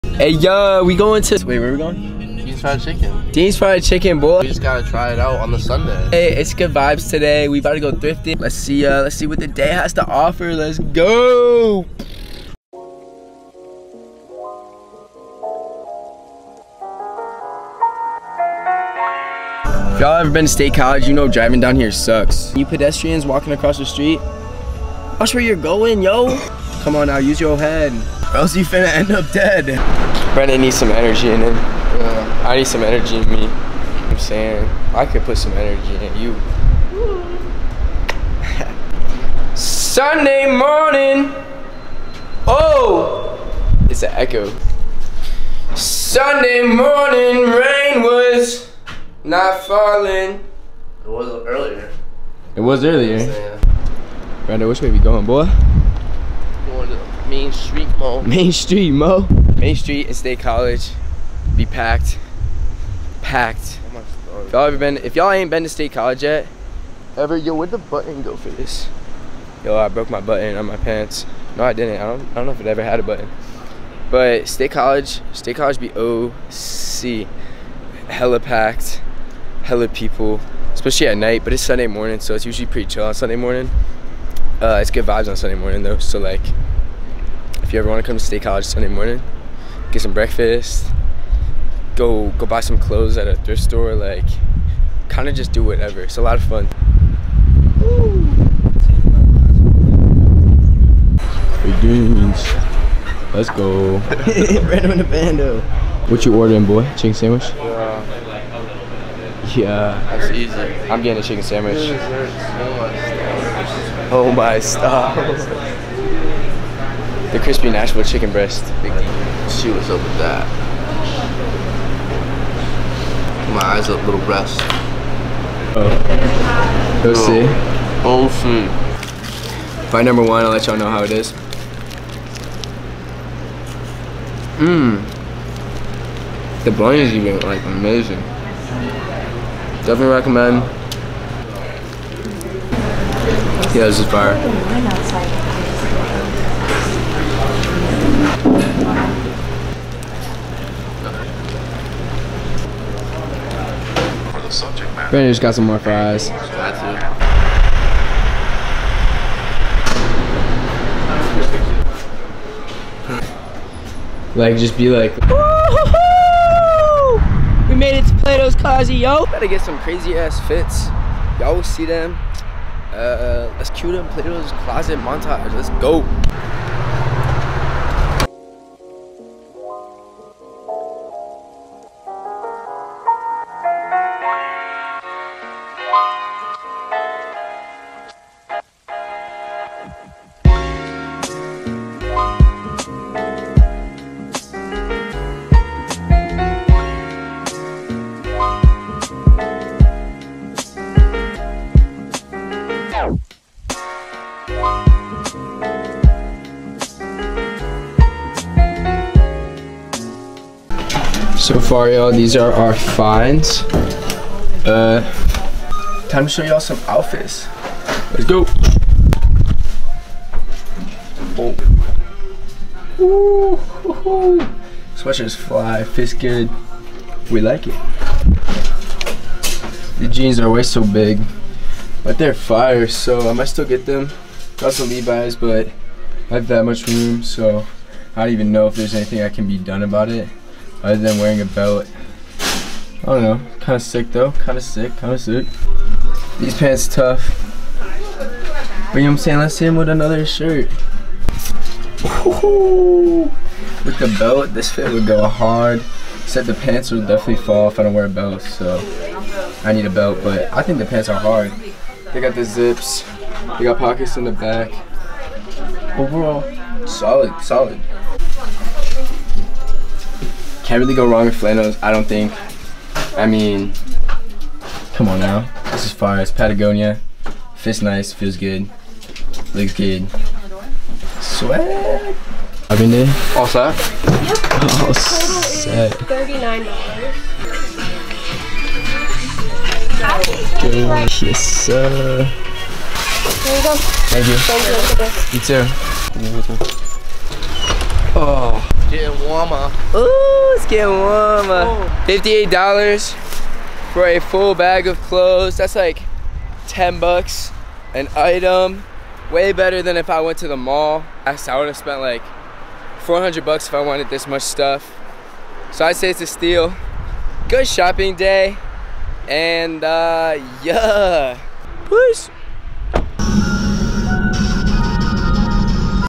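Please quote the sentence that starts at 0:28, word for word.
Or else you finna end up dead.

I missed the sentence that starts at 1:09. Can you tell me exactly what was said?
Yo, I broke my button on my pants.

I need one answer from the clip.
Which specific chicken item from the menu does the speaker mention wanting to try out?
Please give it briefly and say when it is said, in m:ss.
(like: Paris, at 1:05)
Crispy Nashville chicken breast, at 1:57.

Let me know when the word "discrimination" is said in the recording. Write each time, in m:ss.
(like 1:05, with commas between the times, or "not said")
not said.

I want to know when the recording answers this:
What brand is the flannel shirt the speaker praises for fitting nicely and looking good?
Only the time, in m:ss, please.
4:36.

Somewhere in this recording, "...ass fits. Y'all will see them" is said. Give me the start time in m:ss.
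2:50.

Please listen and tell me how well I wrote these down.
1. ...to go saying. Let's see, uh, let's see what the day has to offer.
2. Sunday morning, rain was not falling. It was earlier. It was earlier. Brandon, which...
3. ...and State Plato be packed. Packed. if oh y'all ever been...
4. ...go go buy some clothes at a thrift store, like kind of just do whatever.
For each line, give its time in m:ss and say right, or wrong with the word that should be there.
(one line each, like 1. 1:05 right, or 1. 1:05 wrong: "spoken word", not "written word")
1. 0:07 wrong: "thrifting", not "saying"
2. 0:45 right
3. 1:00 wrong: "College", not "Plato"
4. 1:31 right.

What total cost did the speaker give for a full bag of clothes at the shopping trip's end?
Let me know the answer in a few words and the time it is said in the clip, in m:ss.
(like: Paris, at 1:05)
$58, at 5:02.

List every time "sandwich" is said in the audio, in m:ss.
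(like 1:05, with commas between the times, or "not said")
1:47, 1:51.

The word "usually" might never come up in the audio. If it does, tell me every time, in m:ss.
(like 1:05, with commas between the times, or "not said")
1:22.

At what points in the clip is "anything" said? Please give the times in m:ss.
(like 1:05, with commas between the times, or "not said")
3:58.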